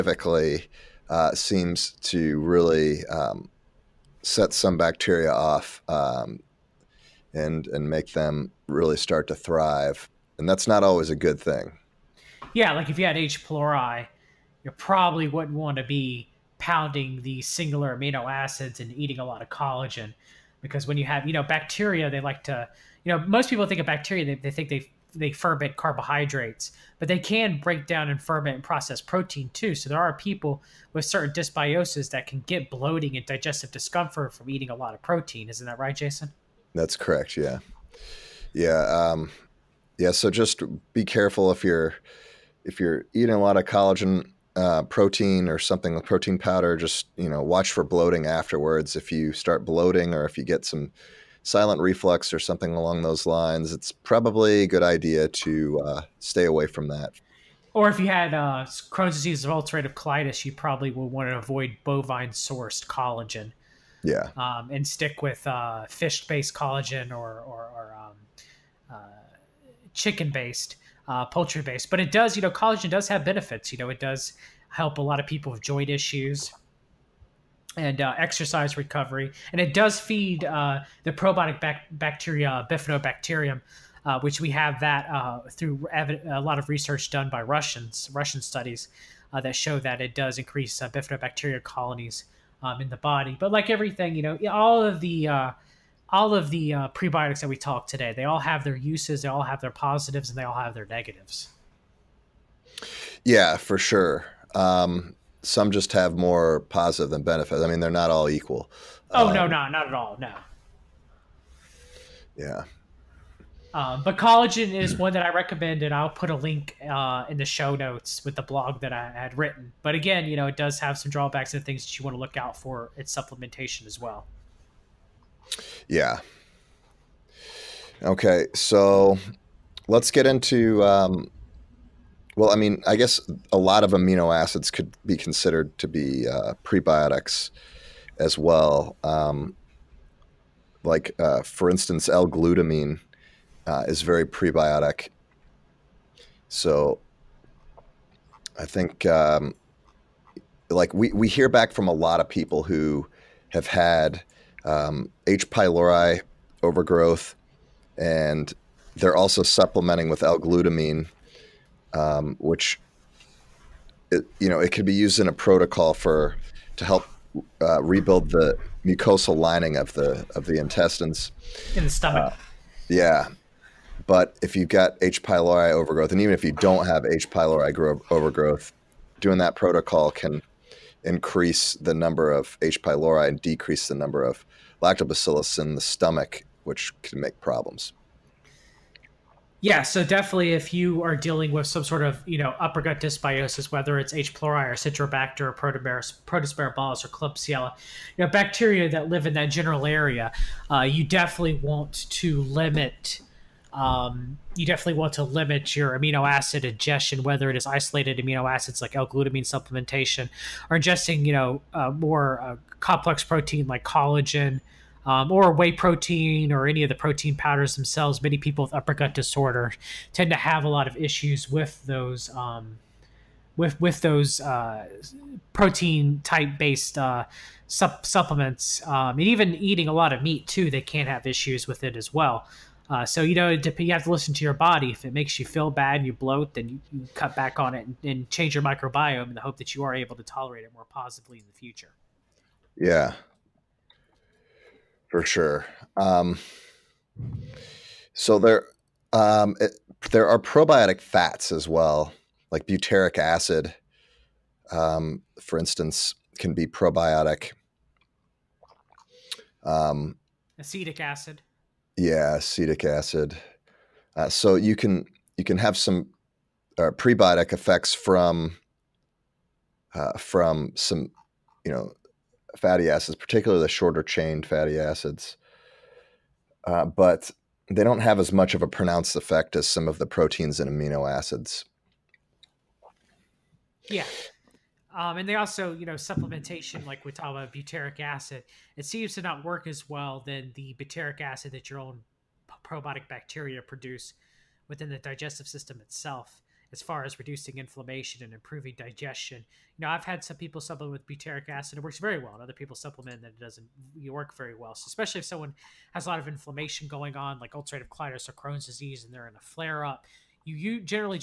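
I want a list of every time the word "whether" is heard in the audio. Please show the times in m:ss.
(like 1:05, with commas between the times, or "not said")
3:13, 3:27.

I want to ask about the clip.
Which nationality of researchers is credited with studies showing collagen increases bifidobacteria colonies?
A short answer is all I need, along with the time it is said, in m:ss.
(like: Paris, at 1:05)
Russian, at 1:27.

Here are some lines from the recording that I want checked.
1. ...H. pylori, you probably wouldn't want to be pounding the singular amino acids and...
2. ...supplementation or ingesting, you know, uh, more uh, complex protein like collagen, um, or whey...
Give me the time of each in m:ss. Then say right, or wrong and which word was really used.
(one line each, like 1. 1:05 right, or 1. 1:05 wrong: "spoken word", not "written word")
1. 0:13 right
2. 3:29 right.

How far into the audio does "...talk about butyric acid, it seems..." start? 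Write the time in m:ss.
4:47.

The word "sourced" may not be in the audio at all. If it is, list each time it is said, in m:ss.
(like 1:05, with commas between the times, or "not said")
1:02.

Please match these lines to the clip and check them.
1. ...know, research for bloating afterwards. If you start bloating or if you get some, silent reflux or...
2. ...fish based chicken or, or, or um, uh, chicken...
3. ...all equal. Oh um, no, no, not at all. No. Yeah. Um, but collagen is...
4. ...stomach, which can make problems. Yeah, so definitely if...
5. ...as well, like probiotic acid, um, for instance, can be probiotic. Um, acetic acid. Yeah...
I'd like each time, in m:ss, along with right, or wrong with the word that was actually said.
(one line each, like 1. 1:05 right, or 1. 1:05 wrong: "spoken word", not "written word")
1. 0:47 wrong: "watch", not "research"
2. 1:05 wrong: "collagen", not "chicken"
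3. 1:48 right
4. 3:05 right
5. 4:11 wrong: "butyric", not "probiotic".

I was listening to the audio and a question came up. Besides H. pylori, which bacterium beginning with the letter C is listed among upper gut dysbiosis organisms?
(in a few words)
Citrobacter.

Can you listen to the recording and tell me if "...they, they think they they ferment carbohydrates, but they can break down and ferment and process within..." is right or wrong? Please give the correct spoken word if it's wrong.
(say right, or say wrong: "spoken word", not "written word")
wrong: "protein", not "within".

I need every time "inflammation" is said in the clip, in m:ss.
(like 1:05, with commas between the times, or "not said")
4:57, 5:06.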